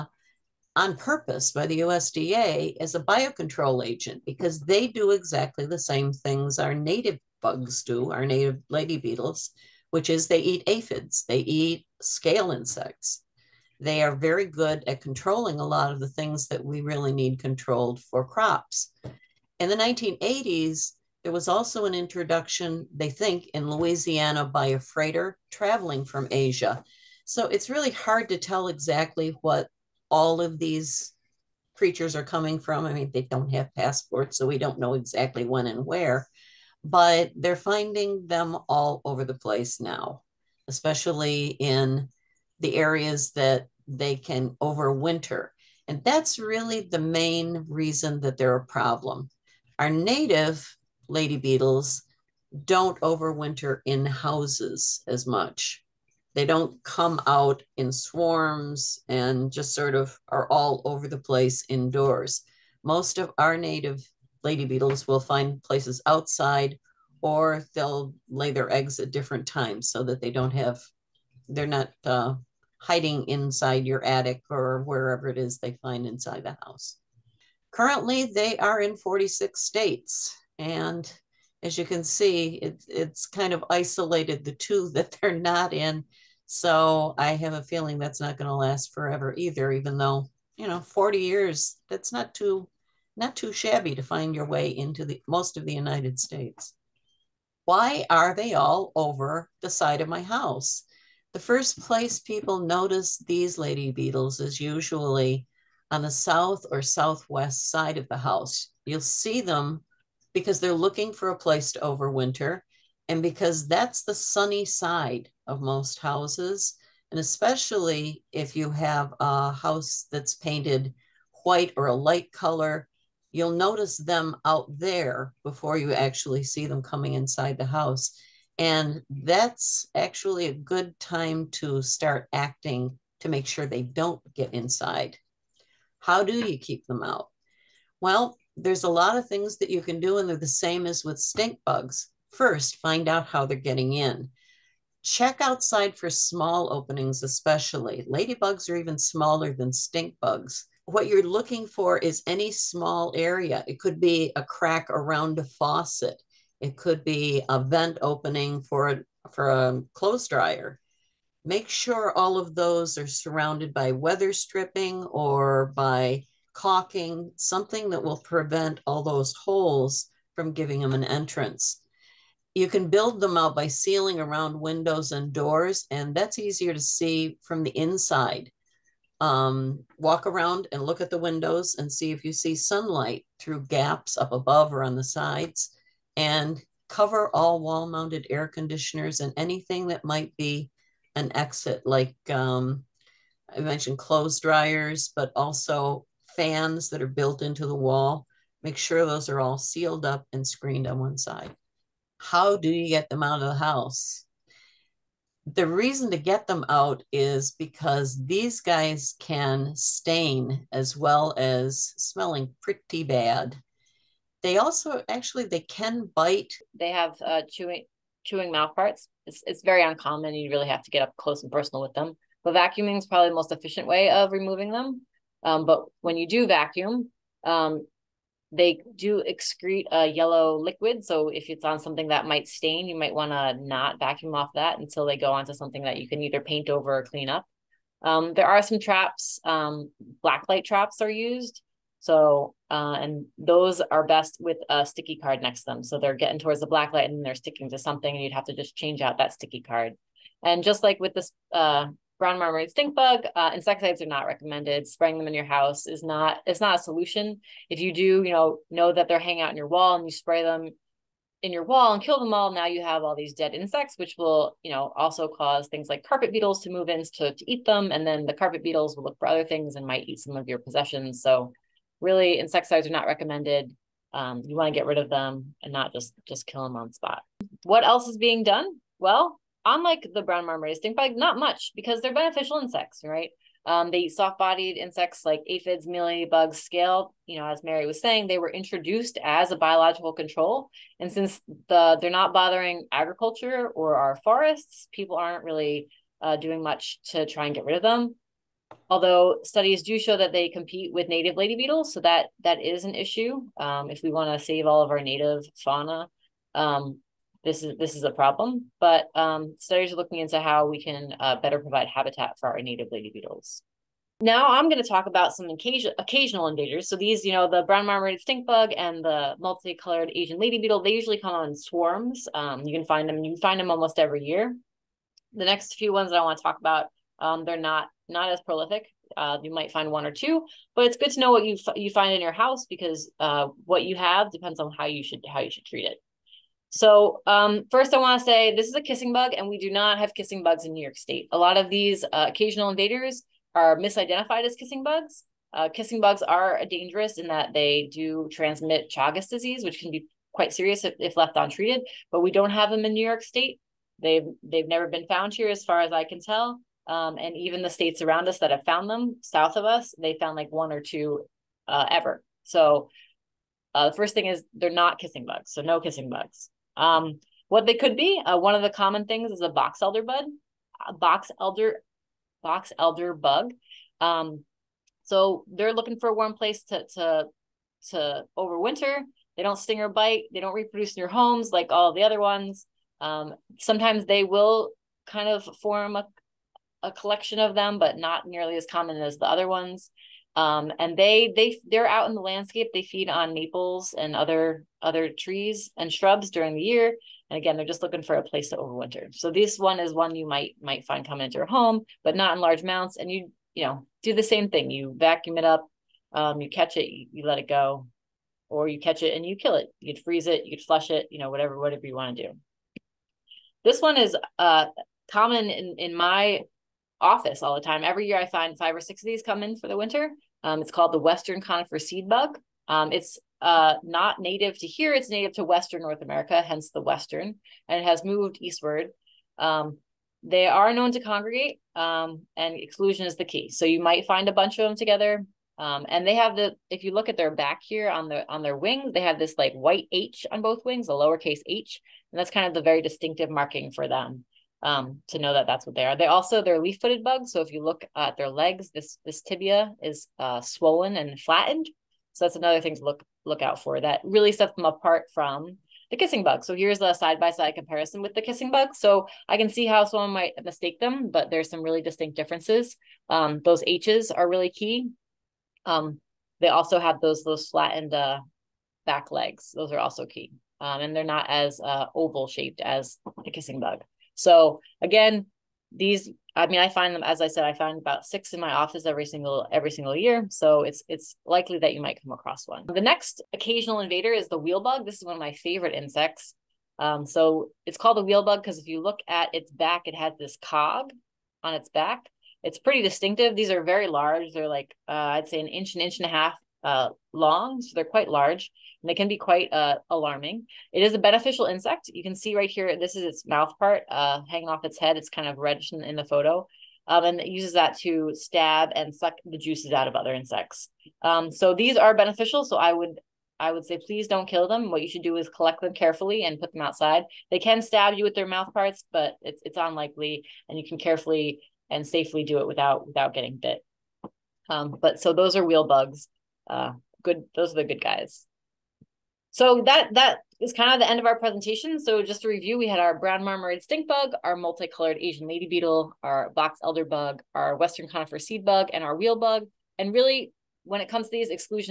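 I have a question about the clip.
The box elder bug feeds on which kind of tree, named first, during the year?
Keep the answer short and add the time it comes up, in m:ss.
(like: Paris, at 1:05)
maples, at 6:33.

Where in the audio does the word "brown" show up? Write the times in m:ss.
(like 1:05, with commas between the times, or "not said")
4:12, 4:40, 5:17, 8:52.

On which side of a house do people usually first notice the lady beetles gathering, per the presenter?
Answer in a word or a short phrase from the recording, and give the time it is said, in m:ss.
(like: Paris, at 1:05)
south or southwest, at 1:46.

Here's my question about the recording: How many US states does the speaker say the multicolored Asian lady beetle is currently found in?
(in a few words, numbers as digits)
46.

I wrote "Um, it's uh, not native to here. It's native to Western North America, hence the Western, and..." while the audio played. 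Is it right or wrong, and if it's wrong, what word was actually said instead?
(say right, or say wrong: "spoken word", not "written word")
right.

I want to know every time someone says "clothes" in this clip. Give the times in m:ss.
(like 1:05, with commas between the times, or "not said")
2:39, 3:13.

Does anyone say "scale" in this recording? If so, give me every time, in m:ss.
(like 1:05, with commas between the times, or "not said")
0:12, 4:46.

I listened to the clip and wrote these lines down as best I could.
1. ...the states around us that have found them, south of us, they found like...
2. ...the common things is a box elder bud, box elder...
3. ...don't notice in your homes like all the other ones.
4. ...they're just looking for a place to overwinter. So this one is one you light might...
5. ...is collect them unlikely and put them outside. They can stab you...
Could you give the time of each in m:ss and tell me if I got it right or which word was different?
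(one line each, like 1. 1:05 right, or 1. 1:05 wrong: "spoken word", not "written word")
1. 5:57 right
2. 6:08 right
3. 6:20 wrong: "reproduce", not "notice"
4. 6:37 wrong: "might", not "light"
5. 8:35 wrong: "carefully", not "unlikely".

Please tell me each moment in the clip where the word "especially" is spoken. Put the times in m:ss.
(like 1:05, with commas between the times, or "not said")
0:40, 1:57, 2:27.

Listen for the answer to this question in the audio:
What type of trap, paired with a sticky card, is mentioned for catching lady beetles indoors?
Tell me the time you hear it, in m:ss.
4:00.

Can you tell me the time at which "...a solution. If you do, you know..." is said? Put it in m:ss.
4:16.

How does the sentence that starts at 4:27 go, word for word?
And then the carpet beetles will look for other things and might eat some of your possessions.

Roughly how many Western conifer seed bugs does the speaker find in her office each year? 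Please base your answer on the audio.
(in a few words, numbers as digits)
6.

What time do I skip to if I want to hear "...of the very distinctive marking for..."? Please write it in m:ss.
7:22.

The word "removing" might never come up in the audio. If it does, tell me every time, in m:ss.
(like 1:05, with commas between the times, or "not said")
3:44.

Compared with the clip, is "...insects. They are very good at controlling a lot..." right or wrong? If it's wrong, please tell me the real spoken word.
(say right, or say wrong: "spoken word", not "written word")
right.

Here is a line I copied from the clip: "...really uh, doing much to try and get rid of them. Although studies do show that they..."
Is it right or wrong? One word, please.
right.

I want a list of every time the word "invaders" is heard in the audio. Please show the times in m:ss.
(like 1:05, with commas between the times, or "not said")
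5:16, 5:42, 8:03.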